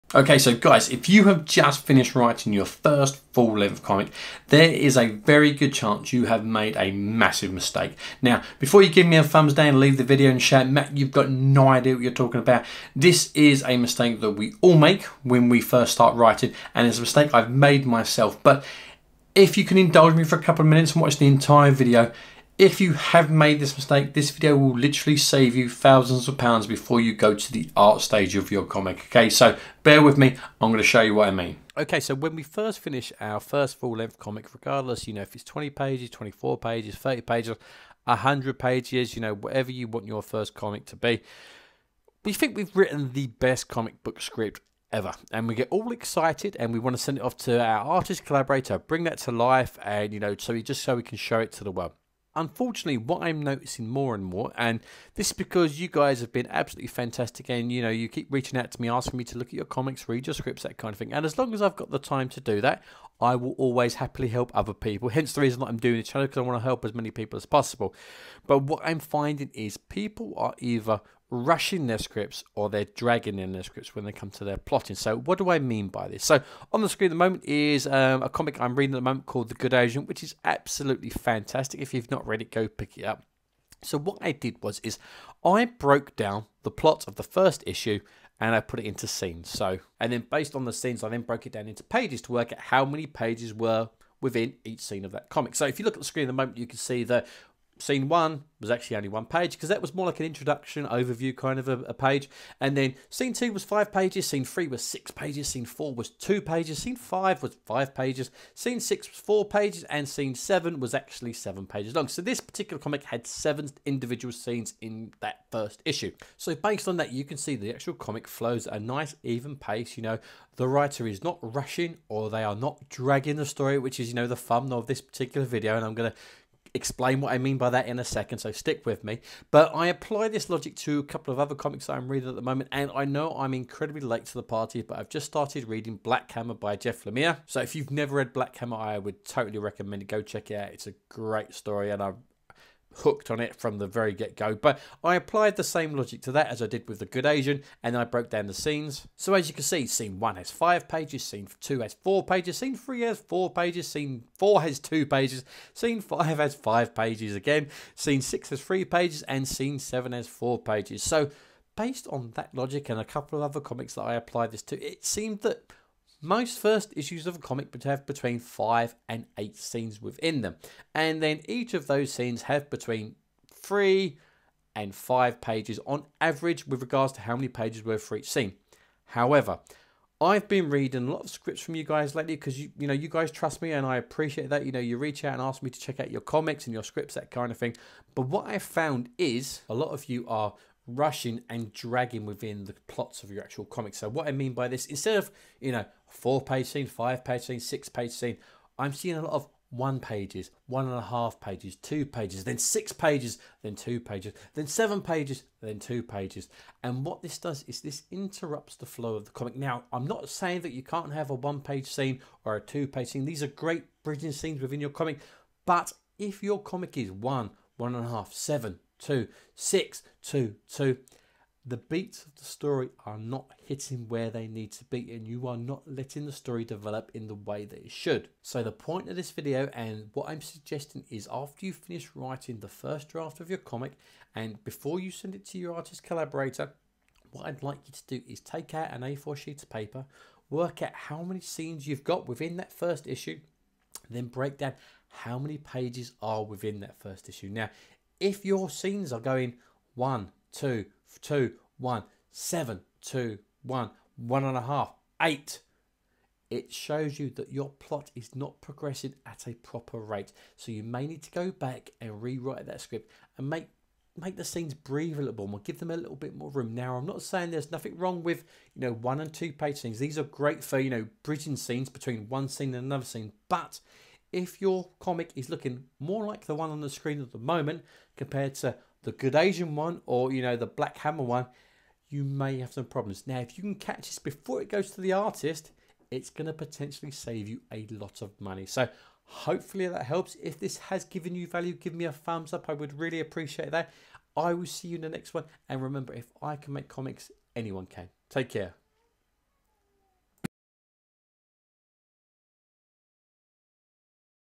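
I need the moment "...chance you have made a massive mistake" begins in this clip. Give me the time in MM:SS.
00:05.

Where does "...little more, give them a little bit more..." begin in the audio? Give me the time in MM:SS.
04:25.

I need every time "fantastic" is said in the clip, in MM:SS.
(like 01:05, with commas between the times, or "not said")
00:56, 01:21.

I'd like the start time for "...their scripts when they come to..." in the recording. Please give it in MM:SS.
01:13.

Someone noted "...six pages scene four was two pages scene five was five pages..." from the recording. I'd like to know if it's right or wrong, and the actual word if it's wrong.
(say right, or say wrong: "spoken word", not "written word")
right.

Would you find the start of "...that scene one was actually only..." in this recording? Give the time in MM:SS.
01:37.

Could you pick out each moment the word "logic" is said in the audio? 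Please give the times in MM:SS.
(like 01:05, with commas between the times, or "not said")
02:10, 02:25, 02:42.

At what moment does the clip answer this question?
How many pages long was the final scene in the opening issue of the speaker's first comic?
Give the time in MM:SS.
01:51.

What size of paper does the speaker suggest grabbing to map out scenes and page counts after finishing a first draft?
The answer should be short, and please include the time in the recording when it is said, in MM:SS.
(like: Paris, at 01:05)
A4, at 03:59.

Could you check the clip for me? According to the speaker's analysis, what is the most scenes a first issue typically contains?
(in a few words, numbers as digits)
8.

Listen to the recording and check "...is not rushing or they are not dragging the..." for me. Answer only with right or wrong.
right.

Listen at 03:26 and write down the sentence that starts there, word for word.
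And what this does is this interrupts the flow of the comic.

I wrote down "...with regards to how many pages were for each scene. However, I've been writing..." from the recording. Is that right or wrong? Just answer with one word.
wrong.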